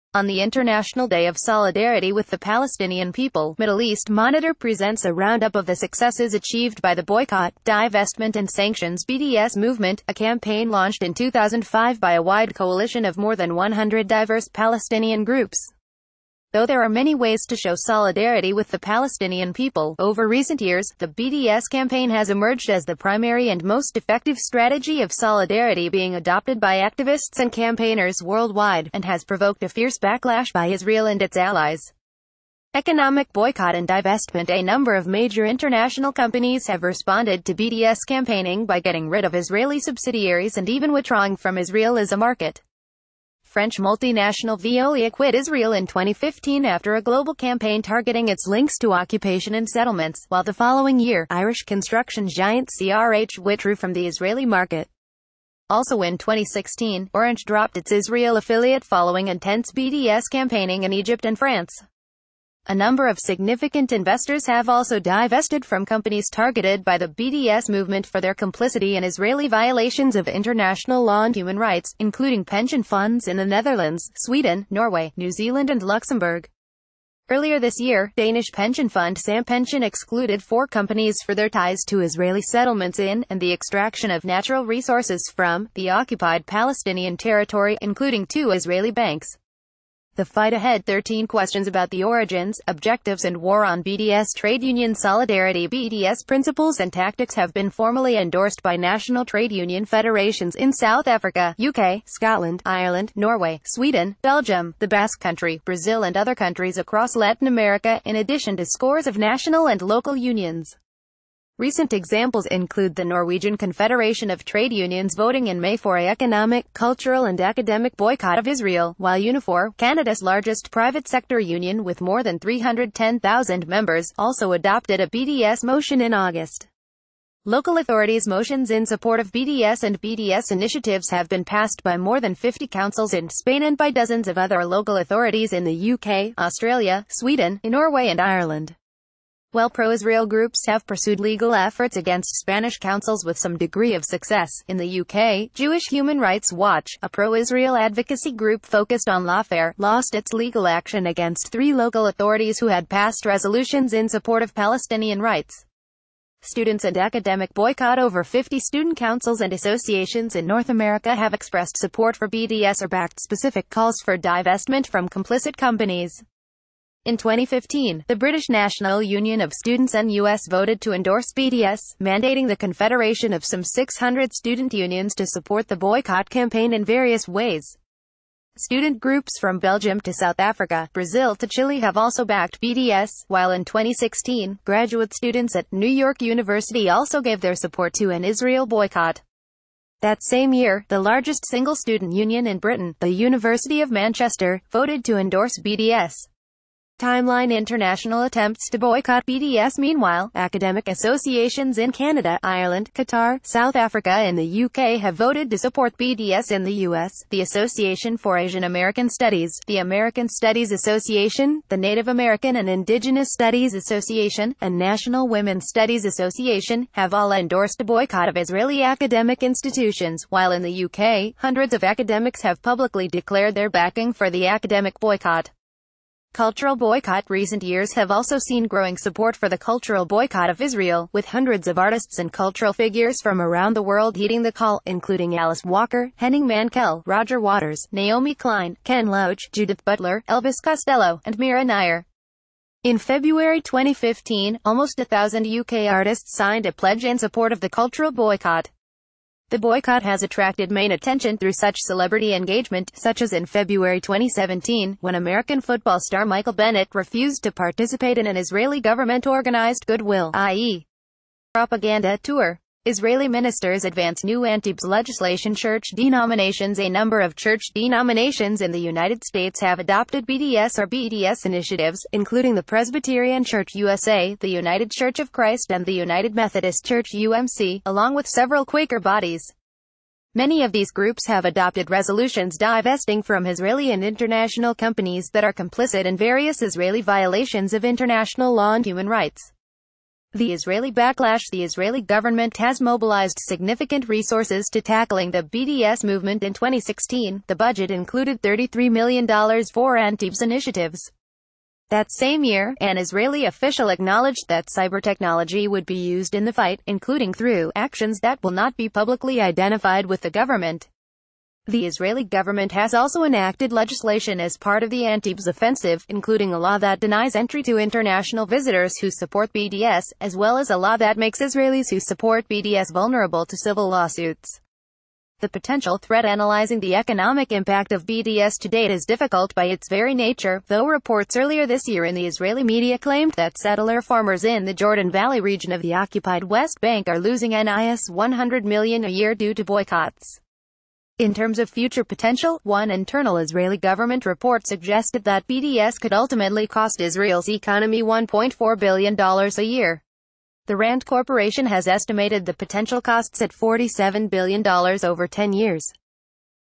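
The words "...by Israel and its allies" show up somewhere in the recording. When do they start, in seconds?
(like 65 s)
30 s.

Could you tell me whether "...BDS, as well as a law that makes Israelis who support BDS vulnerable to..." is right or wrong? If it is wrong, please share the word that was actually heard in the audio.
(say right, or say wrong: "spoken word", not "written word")
right.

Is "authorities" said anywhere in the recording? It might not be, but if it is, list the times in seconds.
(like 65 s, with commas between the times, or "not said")
127 s, 134 s, 152 s.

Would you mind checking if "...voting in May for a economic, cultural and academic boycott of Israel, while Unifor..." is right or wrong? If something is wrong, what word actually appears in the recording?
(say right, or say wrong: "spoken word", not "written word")
right.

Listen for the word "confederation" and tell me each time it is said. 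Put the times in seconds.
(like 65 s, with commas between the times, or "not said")
113 s, 172 s.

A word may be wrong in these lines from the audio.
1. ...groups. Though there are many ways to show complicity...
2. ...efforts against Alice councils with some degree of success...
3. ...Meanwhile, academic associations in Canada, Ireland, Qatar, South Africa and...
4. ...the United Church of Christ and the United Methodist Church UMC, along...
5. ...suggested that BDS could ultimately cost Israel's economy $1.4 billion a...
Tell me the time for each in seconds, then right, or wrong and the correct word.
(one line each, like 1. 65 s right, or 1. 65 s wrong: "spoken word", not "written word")
1. 15 s wrong: "solidarity", not "complicity"
2. 141 s wrong: "Spanish", not "Alice"
3. 199 s right
4. 274 s right
5. 344 s right.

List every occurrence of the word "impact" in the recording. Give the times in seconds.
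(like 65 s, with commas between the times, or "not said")
327 s.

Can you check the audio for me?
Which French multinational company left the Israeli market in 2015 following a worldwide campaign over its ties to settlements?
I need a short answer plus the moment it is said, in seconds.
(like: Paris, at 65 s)
Veolia, at 44 s.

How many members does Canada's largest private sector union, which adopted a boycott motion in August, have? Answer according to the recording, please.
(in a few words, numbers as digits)
310,000.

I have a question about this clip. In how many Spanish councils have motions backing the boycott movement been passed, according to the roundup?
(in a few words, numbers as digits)
more than 50.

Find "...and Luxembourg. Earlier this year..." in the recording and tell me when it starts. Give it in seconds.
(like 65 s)
75 s.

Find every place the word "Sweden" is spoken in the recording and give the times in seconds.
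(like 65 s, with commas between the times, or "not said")
74 s, 103 s, 137 s.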